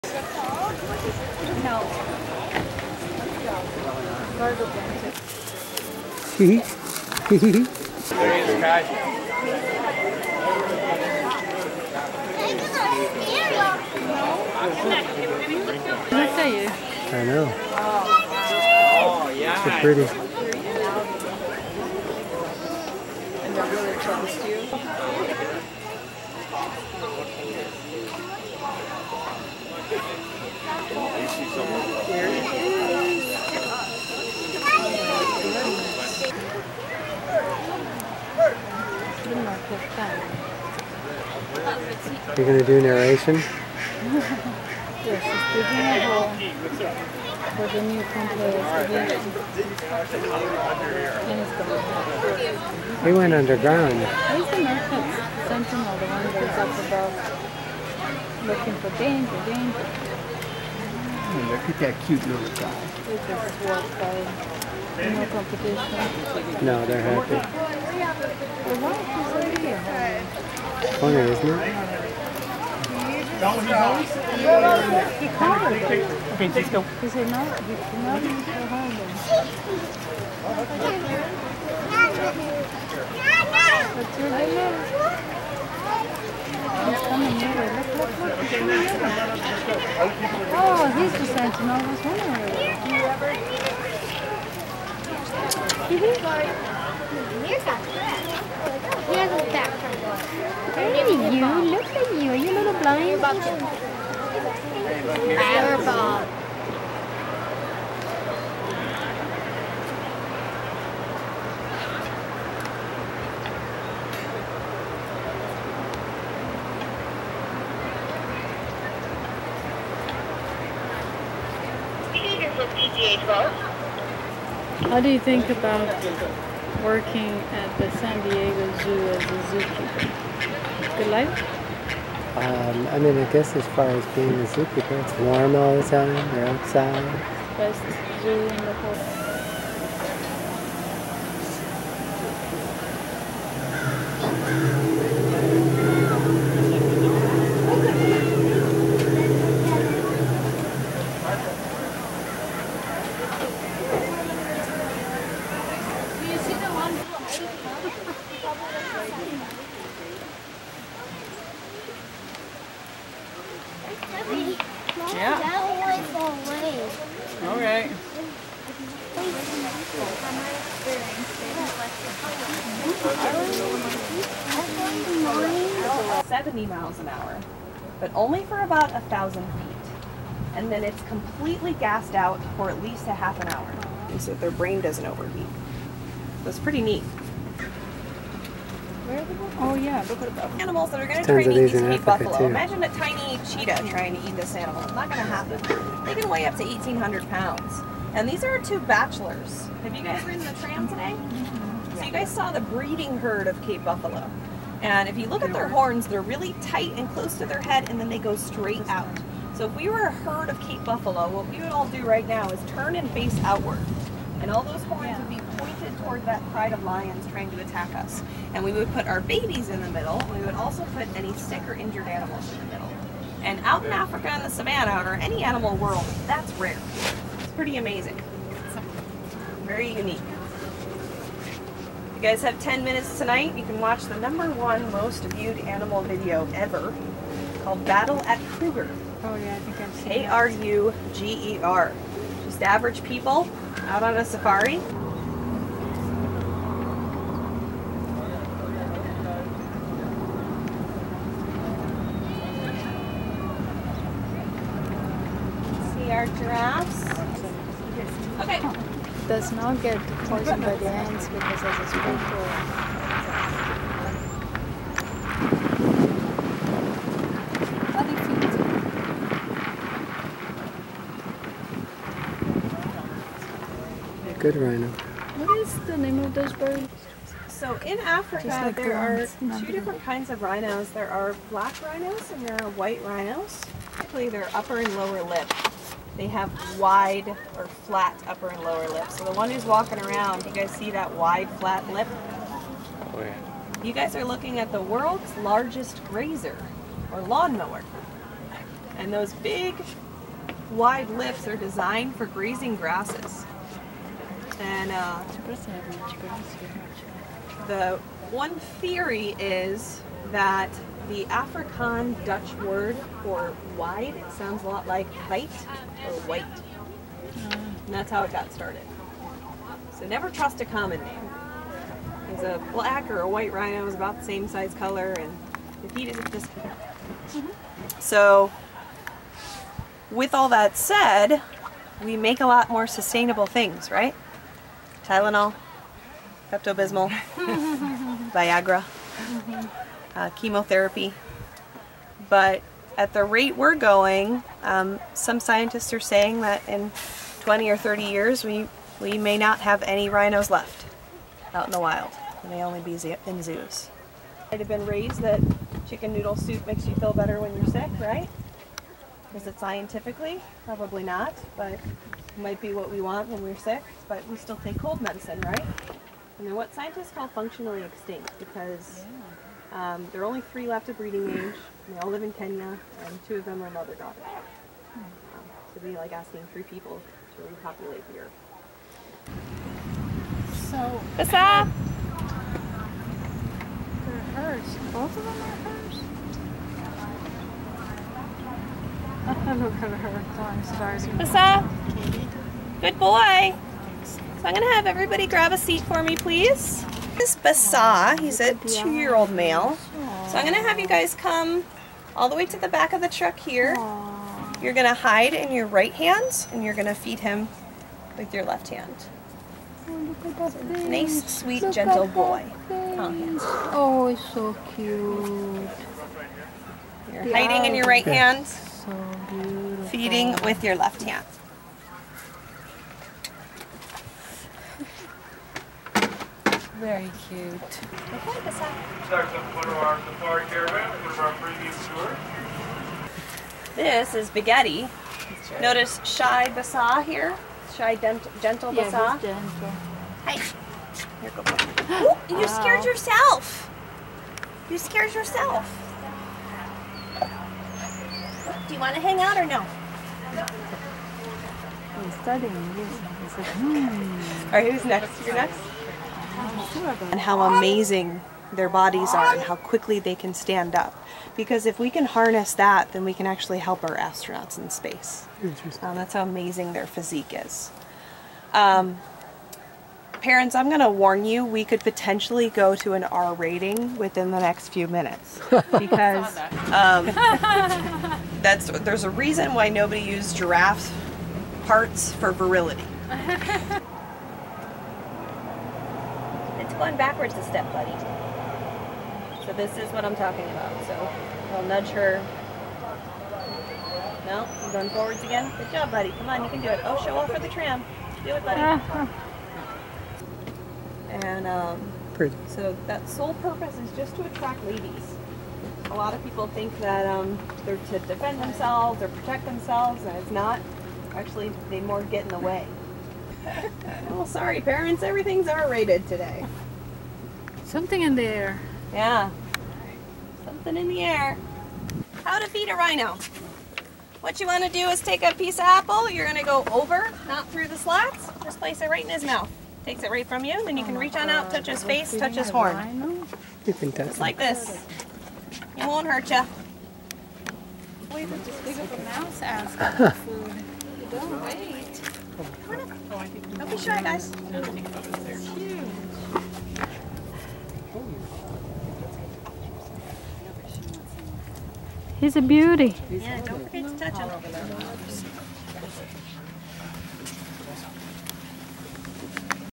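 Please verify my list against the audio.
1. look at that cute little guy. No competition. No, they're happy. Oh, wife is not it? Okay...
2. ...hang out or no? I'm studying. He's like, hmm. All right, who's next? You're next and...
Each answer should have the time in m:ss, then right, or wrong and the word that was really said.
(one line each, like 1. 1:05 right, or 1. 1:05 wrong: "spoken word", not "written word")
1. 1:01 right
2. 7:29 right.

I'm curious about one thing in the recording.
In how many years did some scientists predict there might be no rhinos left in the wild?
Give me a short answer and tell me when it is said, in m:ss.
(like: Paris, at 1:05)
20 or 30 years, at 5:47.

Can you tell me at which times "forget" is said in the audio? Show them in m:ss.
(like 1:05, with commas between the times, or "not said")
9:13.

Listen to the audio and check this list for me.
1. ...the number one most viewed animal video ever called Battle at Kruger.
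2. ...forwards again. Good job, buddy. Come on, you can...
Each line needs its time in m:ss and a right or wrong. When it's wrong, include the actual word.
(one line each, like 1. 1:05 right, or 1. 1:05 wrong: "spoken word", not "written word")
1. 3:54 right
2. 8:14 right.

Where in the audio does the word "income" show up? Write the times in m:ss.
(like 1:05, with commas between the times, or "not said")
not said.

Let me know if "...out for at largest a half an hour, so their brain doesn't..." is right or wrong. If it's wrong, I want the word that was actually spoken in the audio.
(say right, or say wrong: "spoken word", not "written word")
wrong: "least", not "largest".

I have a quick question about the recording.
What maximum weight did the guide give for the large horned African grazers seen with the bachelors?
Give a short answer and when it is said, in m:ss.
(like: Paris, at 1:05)
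1,800 pounds, at 3:16.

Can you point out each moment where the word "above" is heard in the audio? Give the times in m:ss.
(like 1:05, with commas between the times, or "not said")
0:56.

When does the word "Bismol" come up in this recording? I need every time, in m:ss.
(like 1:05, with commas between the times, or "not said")
5:36.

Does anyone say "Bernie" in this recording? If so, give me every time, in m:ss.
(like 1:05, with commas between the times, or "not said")
not said.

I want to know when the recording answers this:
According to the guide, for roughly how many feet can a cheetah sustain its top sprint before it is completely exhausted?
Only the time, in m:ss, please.
2:58.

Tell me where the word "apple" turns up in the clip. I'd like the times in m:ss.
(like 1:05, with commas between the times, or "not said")
8:45.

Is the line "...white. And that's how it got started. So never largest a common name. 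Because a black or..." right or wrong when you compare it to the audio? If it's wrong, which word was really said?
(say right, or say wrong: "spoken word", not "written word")
wrong: "trust", not "largest".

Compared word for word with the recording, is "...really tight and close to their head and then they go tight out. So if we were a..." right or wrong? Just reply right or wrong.
wrong.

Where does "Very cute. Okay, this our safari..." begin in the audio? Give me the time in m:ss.
7:06.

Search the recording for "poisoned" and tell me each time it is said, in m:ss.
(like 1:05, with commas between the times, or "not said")
4:20.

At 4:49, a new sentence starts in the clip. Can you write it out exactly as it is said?
So the one who's walking around, you guys see that wide flat lip?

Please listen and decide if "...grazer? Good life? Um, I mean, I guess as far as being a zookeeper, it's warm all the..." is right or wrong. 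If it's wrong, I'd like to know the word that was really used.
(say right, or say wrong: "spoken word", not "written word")
wrong: "zookeeper", not "grazer".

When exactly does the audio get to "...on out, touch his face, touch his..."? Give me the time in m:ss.
8:51.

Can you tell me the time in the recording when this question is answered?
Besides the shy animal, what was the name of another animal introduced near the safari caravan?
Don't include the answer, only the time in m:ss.
7:14.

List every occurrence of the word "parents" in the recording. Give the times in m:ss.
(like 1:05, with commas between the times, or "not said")
7:50, 8:34.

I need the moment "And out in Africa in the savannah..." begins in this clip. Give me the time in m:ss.
3:43.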